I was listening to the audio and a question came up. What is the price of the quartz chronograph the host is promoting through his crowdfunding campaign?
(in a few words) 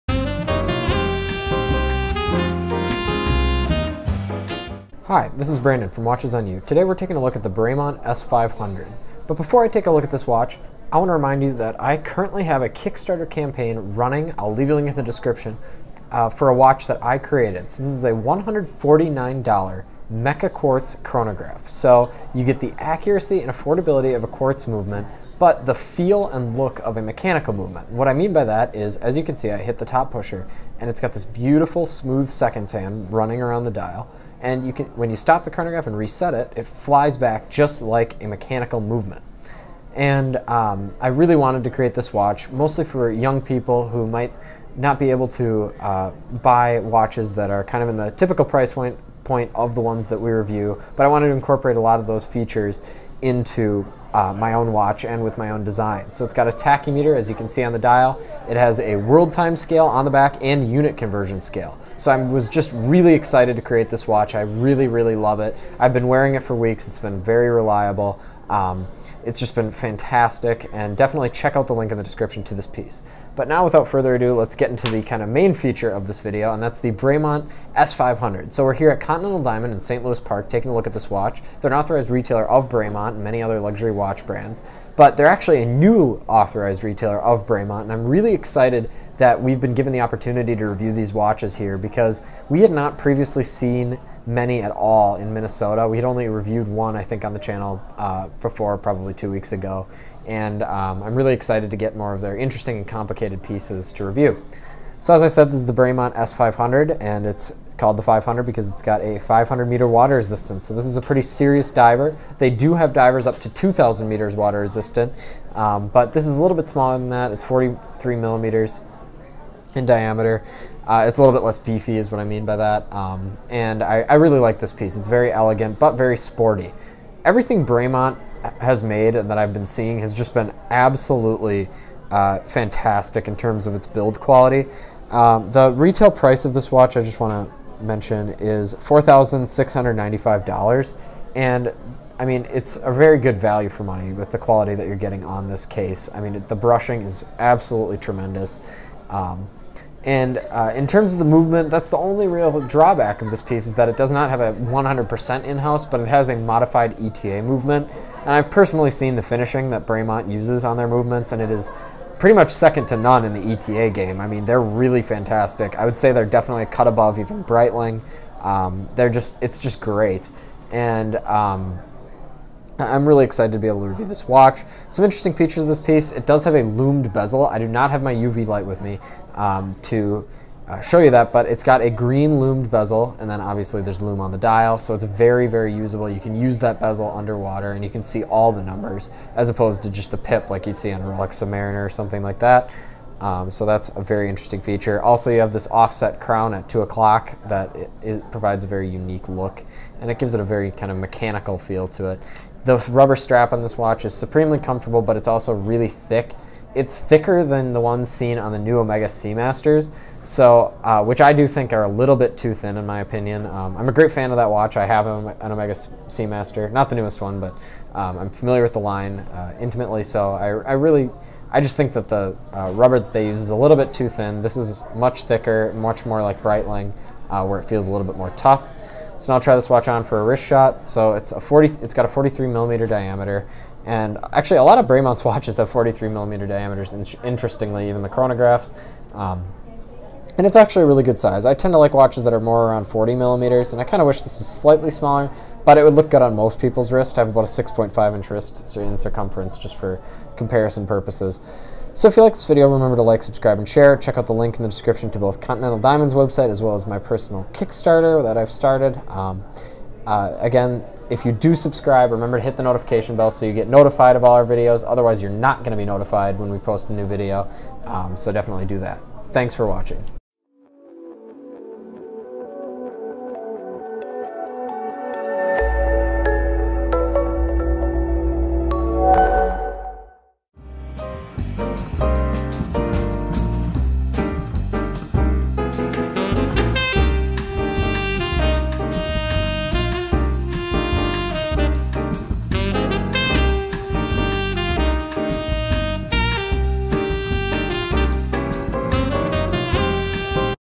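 $149.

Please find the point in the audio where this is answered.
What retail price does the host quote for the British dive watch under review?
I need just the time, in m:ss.
2:18.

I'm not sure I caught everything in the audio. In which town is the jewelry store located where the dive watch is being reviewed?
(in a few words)
St. Louis Park.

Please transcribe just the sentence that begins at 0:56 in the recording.
So it's got a tachymeter, as you can see on the dial.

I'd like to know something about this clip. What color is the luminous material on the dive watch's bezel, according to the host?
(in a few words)
Green.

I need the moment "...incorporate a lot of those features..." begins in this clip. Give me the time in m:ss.
0:51.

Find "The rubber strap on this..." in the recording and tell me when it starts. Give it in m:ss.
3:22.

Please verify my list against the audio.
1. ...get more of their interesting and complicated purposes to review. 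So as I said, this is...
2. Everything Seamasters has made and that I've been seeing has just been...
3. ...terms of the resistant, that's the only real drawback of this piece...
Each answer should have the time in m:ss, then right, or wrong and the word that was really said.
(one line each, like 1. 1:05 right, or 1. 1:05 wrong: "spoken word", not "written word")
1. 1:41 wrong: "pieces", not "purposes"
2. 2:07 wrong: "Bremont", not "Seamasters"
3. 2:30 wrong: "movement", not "resistant".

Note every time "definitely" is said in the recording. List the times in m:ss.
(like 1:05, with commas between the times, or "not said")
1:10, 2:46, 4:28.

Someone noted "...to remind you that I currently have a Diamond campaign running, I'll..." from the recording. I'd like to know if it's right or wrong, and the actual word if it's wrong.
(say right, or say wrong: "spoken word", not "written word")
wrong: "Kickstarter", not "Diamond".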